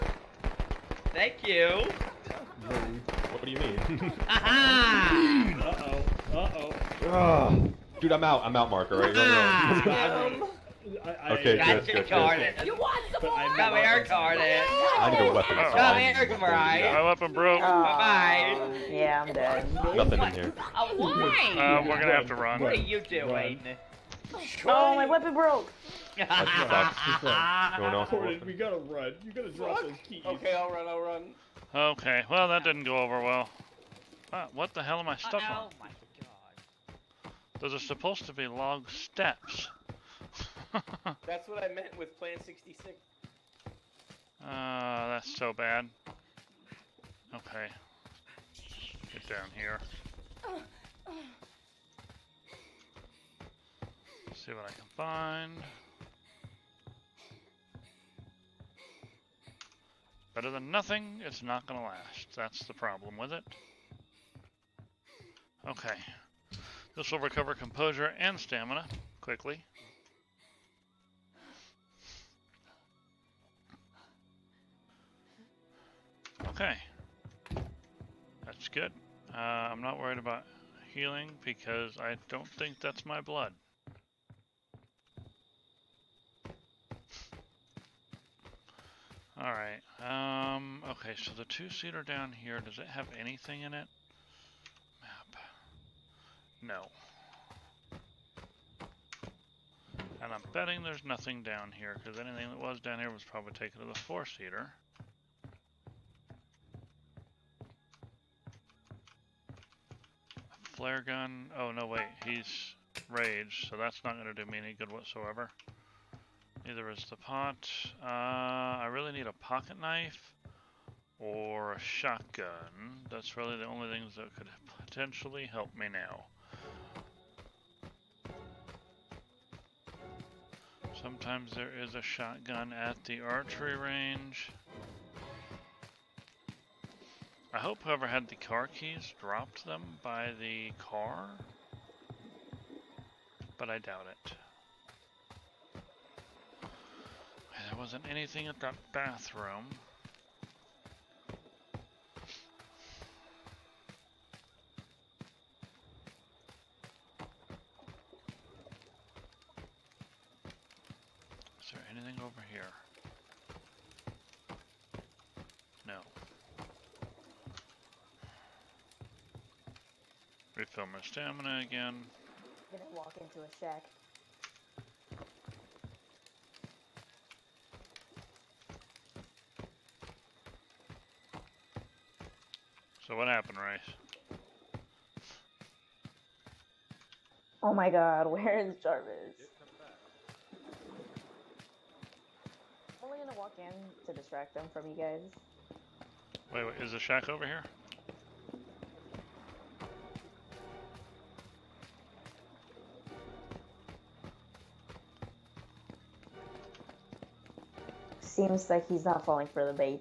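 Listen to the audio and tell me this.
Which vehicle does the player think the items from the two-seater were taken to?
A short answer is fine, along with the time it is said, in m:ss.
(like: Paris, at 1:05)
The four-seater, at 1:43.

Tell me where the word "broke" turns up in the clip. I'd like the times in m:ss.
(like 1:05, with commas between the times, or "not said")
0:17, 0:25.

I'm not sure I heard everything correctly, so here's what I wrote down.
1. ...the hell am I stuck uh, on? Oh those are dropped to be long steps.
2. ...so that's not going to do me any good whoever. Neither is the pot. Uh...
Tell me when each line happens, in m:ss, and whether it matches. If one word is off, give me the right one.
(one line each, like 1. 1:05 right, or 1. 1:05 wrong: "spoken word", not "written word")
1. 0:34 wrong: "supposed", not "dropped"
2. 1:53 wrong: "whatsoever", not "whoever".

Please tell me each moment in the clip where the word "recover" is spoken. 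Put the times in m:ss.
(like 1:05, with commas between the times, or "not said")
1:07.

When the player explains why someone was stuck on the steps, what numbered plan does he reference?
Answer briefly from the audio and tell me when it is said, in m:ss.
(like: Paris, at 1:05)
Plan 66, at 0:42.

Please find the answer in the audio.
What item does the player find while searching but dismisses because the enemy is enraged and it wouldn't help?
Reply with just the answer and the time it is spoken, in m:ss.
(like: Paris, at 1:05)
Flare gun, at 1:50.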